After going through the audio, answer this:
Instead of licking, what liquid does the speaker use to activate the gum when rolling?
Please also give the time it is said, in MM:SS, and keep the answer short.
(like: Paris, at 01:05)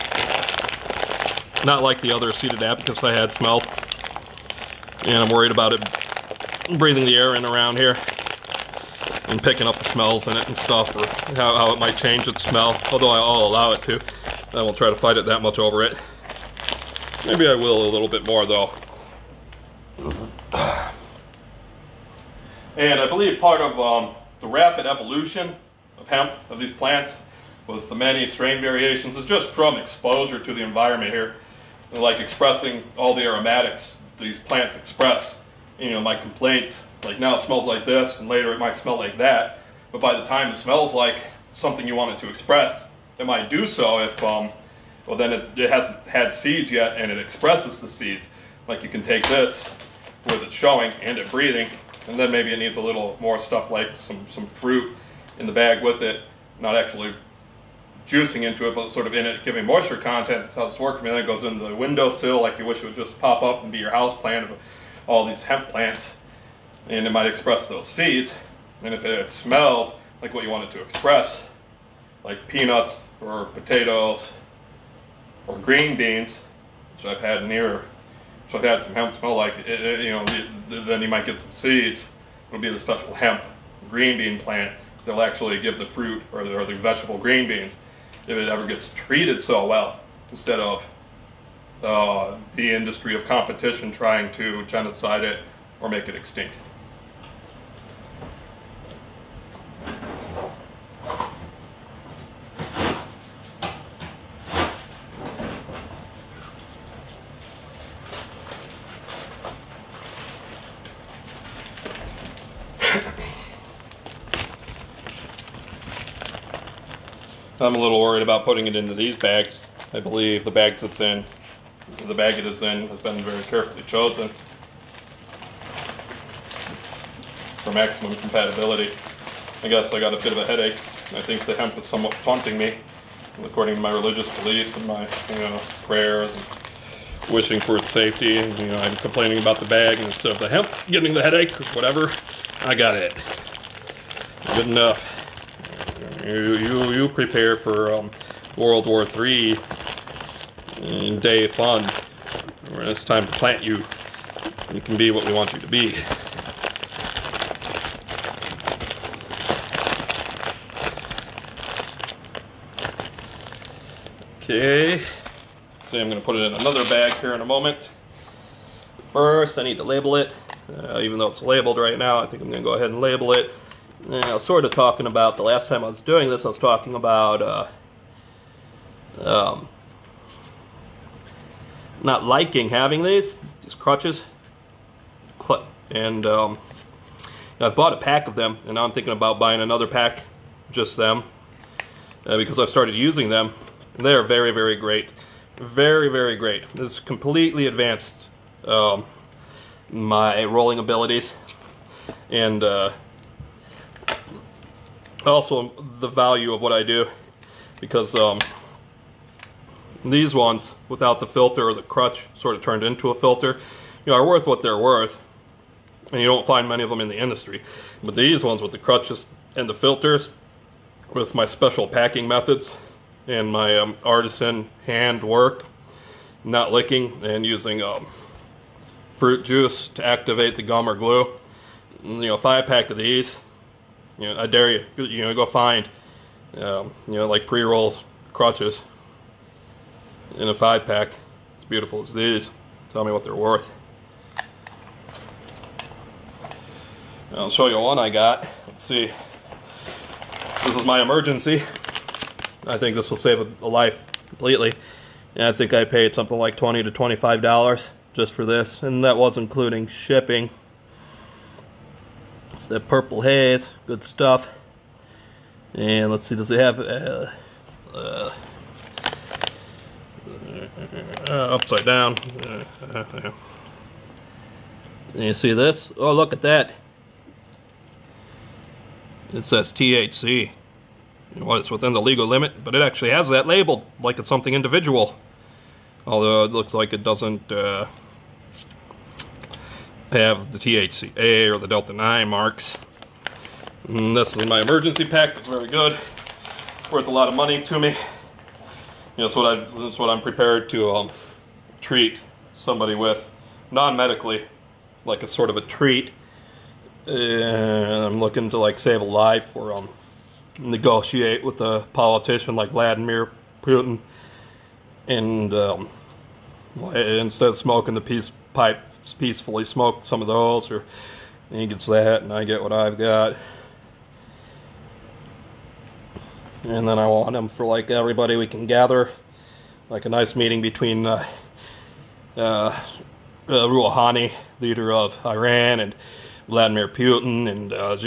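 fruit juice, at 03:49.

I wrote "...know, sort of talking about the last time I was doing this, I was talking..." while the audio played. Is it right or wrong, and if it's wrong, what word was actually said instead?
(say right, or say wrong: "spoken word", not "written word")
right.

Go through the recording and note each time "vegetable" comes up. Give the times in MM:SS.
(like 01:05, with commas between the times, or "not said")
01:26.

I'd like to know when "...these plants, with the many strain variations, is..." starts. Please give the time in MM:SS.
00:26.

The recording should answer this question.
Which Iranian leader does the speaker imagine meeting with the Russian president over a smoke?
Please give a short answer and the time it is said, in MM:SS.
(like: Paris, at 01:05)
Rouhani, at 05:33.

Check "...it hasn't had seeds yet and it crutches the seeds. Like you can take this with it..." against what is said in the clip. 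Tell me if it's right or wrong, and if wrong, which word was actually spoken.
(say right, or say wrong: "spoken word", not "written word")
wrong: "expresses", not "crutches".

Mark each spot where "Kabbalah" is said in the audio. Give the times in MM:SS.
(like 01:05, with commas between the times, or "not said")
not said.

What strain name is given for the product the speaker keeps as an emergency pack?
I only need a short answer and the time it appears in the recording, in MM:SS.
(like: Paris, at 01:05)
purple haze, at 04:22.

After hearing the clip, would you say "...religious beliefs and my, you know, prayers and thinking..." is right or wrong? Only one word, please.
wrong.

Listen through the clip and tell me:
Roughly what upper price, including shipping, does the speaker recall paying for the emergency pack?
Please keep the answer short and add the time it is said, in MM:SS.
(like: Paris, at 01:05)
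$25, at 04:16.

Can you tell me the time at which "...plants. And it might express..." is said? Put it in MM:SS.
01:05.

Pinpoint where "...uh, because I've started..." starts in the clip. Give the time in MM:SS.
03:12.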